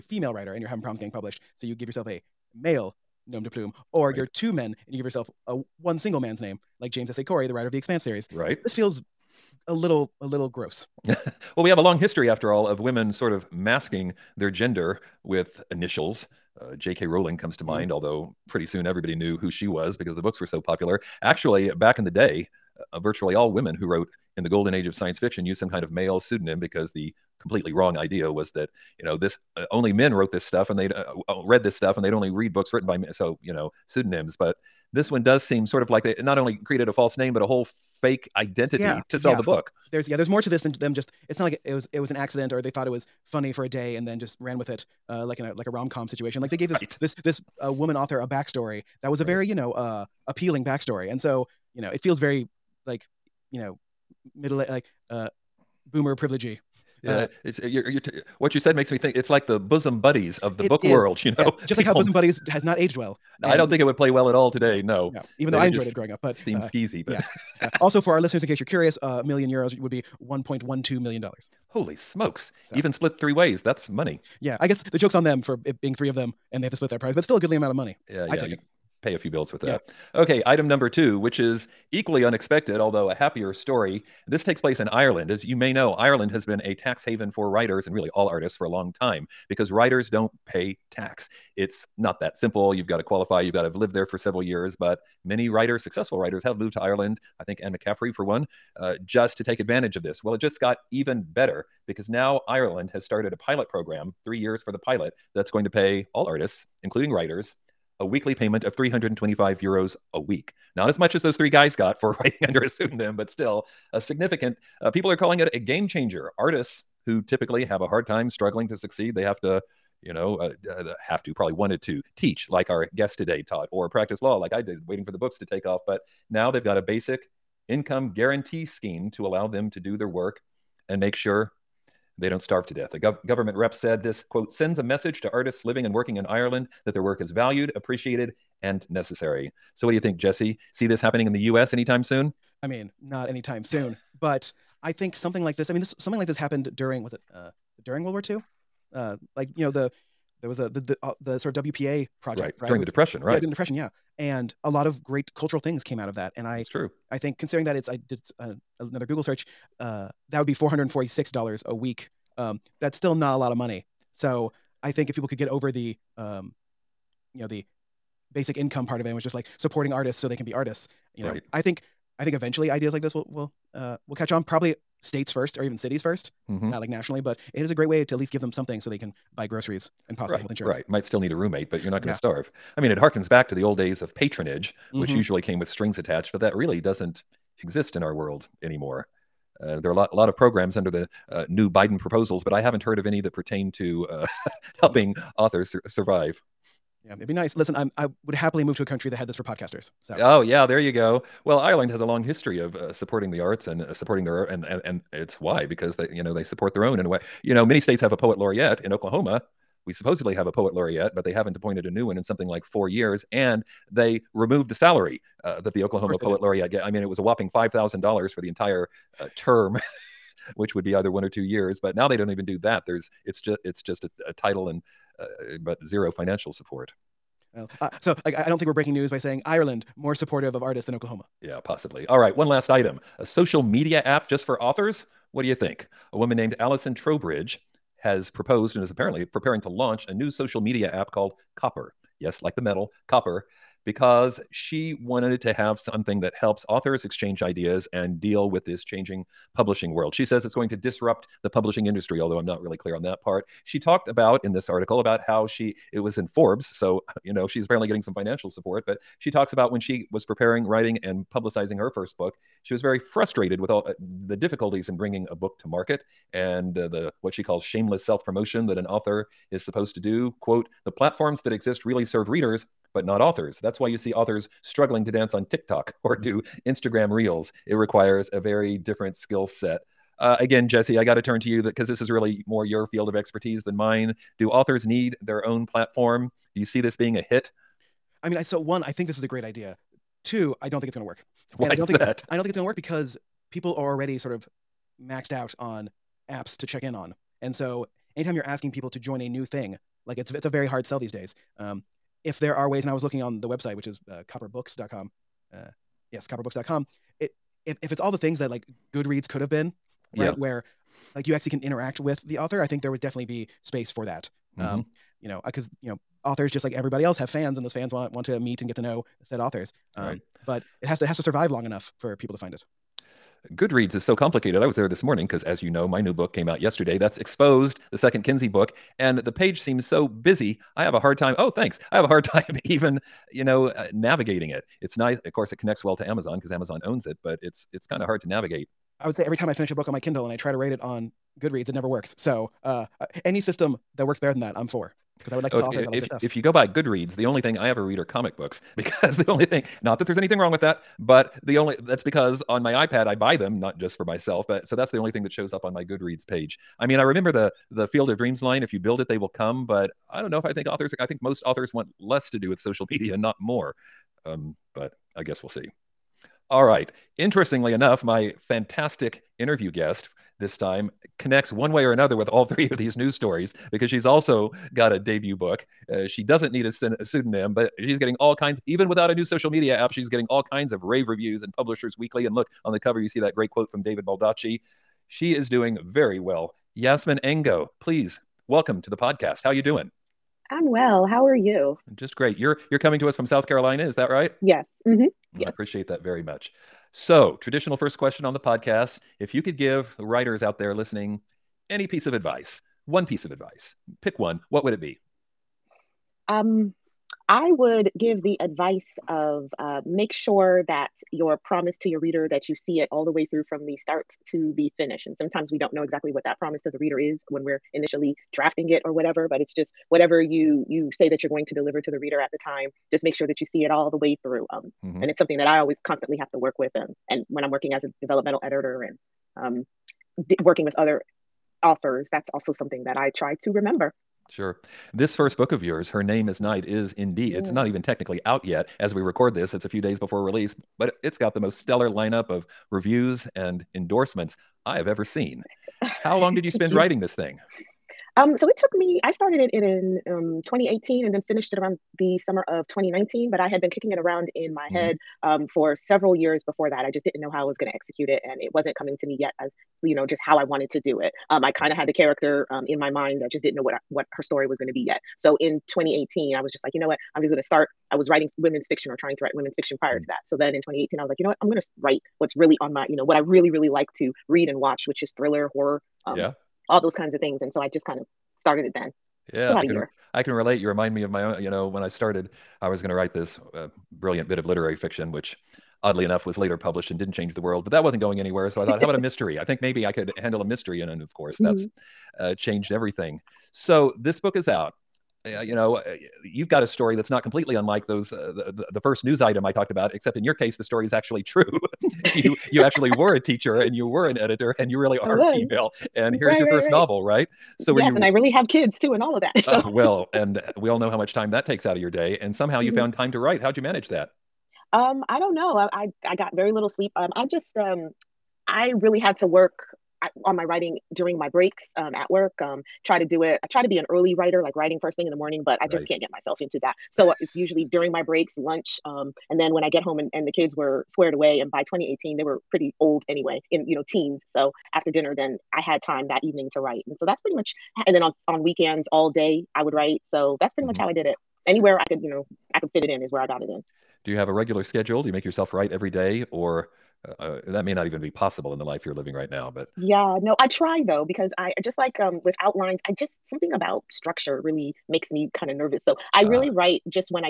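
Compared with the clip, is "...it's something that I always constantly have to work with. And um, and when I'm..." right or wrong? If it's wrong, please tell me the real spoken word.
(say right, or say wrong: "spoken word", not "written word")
right.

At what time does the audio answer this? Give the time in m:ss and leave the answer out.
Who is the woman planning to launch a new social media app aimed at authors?
3:56.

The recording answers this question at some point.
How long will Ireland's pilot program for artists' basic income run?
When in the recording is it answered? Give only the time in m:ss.
1:44.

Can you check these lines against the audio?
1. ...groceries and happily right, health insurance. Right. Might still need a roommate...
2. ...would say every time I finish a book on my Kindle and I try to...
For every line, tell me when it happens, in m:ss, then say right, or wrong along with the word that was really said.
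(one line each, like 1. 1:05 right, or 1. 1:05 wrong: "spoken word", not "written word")
1. 2:59 wrong: "possibly", not "happily"
2. 5:39 right.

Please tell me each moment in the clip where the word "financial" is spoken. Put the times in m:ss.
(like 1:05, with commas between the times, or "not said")
3:46, 4:18.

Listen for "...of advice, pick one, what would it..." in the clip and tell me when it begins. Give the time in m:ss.
6:43.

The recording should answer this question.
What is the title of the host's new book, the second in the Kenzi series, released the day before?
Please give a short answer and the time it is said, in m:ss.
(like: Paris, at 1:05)
Exposed, at 5:27.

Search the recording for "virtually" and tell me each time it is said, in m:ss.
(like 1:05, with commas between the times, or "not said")
0:22.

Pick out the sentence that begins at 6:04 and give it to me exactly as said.
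Um, but I guess we'll see.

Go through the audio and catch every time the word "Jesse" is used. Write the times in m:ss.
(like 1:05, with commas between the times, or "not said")
2:20, 4:40.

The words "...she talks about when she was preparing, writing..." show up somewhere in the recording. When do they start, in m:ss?
4:19.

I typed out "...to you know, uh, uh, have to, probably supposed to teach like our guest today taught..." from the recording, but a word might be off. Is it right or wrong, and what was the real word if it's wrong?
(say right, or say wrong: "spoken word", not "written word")
wrong: "wanted", not "supposed".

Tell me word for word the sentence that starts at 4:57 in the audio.
And so anytime you're asking people to join a new thing, like it's it's a very hard sell these days.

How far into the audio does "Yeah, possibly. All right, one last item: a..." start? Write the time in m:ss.
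3:51.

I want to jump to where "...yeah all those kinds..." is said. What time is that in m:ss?
7:56.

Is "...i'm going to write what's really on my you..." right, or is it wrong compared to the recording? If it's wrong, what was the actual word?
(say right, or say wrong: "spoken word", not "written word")
right.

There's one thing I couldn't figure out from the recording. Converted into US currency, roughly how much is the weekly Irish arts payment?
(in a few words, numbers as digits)
$446.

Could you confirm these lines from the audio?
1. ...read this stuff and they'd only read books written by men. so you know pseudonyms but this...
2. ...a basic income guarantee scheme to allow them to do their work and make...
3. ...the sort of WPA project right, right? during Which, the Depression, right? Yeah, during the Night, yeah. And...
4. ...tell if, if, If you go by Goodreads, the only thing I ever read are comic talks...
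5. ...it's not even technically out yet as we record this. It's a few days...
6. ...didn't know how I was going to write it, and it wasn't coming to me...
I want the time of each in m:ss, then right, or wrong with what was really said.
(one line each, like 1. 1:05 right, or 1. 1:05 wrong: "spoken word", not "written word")
1. 0:31 right
2. 2:06 right
3. 2:31 wrong: "Depression", not "Night"
4. 5:45 wrong: "books", not "talks"
5. 7:17 right
6. 7:37 wrong: "execute", not "write".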